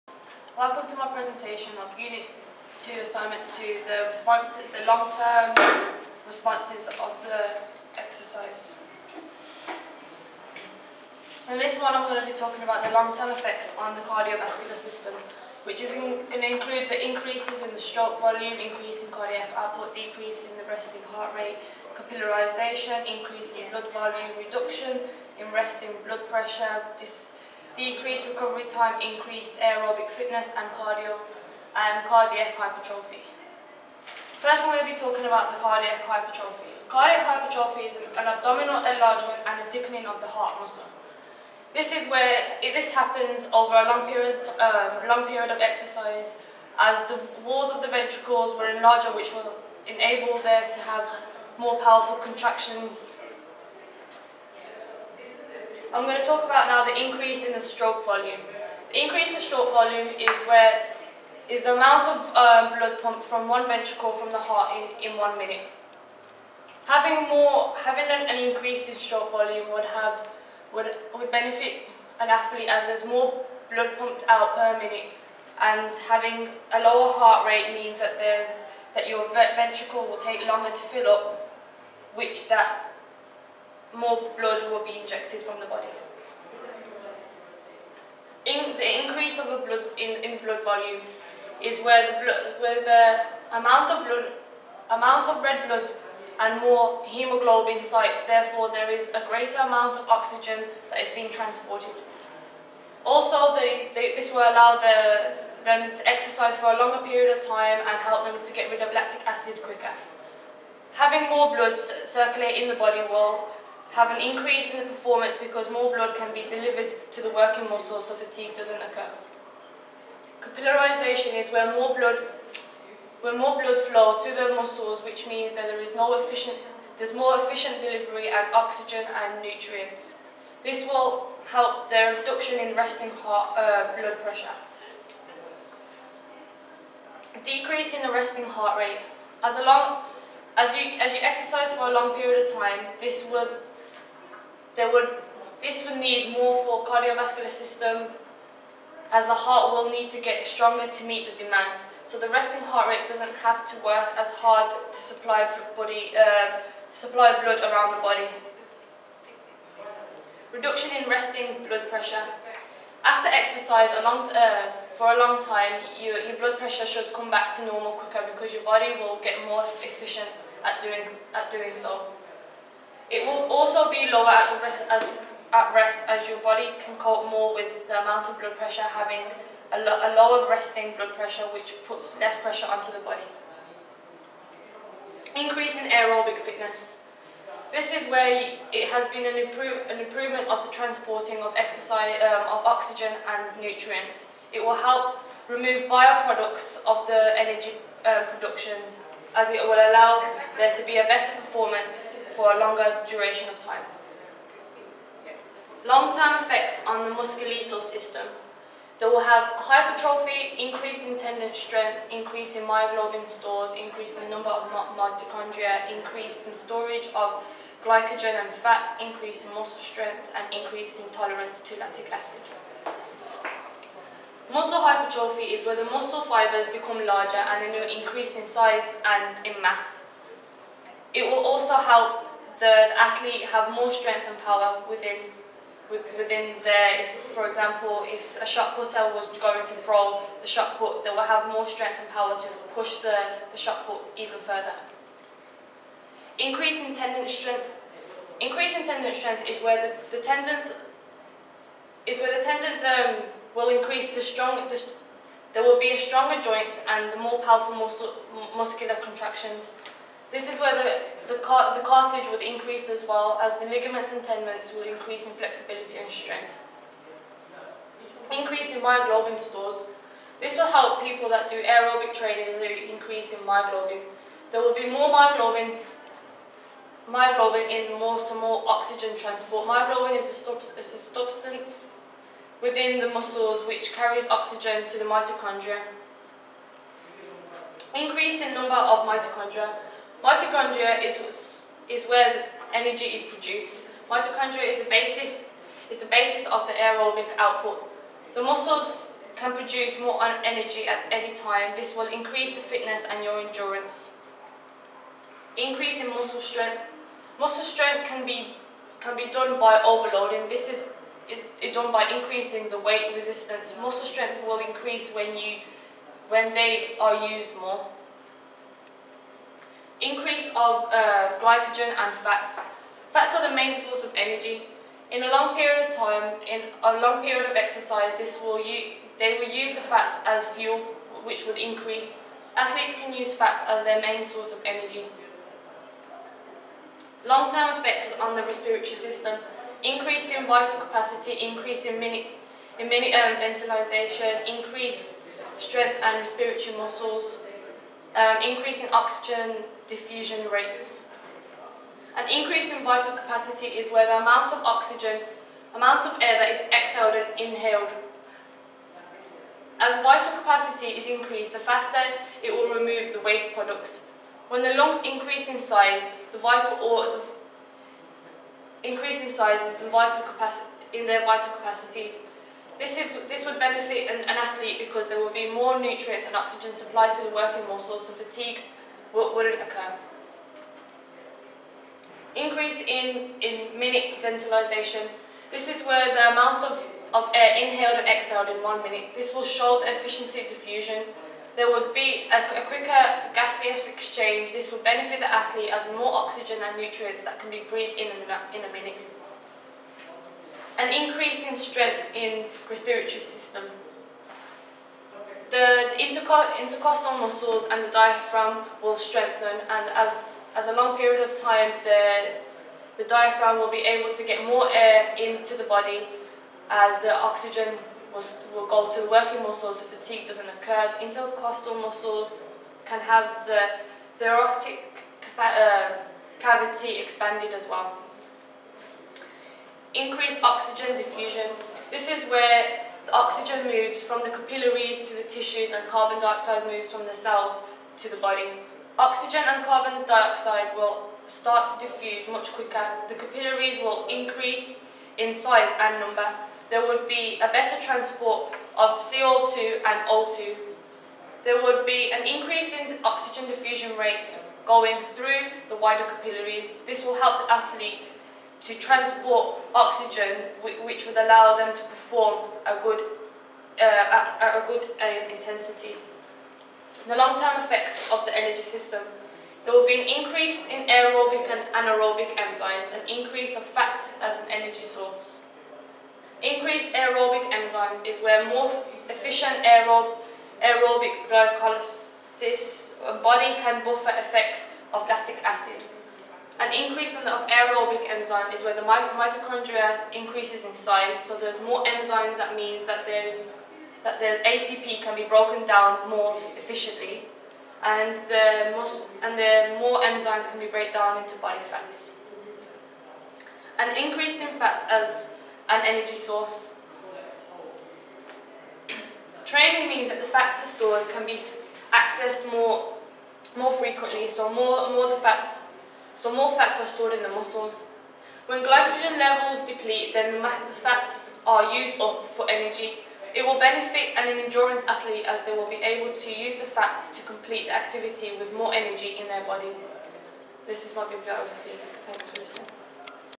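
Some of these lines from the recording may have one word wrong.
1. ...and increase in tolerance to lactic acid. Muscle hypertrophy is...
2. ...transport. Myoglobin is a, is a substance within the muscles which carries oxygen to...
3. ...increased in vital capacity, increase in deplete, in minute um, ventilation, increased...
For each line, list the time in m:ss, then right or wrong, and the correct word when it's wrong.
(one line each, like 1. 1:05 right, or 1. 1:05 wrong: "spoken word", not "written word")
1. 3:40 right
2. 4:39 right
3. 5:39 wrong: "minute", not "deplete".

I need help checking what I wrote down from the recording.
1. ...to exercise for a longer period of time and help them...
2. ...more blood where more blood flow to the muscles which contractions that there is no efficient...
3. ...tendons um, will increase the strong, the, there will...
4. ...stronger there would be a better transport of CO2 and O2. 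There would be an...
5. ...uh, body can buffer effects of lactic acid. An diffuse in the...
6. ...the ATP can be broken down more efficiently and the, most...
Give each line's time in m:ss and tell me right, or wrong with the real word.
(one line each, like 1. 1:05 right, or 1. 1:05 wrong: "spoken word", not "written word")
1. 1:45 right
2. 2:01 wrong: "means", not "contractions"
3. 4:12 right
4. 7:25 wrong: "number", not "stronger"
5. 8:03 wrong: "increase", not "diffuse"
6. 8:14 right.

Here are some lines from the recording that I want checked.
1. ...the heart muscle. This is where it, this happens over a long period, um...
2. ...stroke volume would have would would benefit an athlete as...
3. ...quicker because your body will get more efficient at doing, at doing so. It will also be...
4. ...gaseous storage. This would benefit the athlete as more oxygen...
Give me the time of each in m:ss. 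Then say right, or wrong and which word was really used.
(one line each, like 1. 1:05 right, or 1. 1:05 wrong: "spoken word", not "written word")
1. 0:40 right
2. 1:08 right
3. 2:47 right
4. 6:33 wrong: "exchange", not "storage".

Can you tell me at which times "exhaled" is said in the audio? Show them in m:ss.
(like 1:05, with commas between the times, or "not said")
5:56, 6:28.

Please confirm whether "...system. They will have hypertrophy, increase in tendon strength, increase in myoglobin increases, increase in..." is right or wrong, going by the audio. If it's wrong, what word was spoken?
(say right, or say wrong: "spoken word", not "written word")
wrong: "stores", not "increases".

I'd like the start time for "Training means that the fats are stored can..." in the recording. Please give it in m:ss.
8:29.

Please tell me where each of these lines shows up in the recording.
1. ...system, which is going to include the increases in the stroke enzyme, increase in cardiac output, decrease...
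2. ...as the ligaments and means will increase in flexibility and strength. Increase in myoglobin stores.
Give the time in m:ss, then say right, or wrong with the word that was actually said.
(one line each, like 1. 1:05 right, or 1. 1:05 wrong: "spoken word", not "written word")
1. 0:14 wrong: "volume", not "enzyme"
2. 4:23 wrong: "tendons", not "means".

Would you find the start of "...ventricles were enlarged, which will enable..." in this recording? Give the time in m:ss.
0:47.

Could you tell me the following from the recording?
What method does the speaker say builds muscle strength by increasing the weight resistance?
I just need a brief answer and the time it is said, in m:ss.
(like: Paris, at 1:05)
overloading, at 5:09.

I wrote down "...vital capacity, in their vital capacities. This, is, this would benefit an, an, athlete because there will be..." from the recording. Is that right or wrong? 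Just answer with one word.
right.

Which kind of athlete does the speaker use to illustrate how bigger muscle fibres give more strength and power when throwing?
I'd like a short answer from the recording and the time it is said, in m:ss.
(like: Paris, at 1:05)
shot putter, at 3:58.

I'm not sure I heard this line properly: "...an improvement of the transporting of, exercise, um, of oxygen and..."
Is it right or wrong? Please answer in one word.
right.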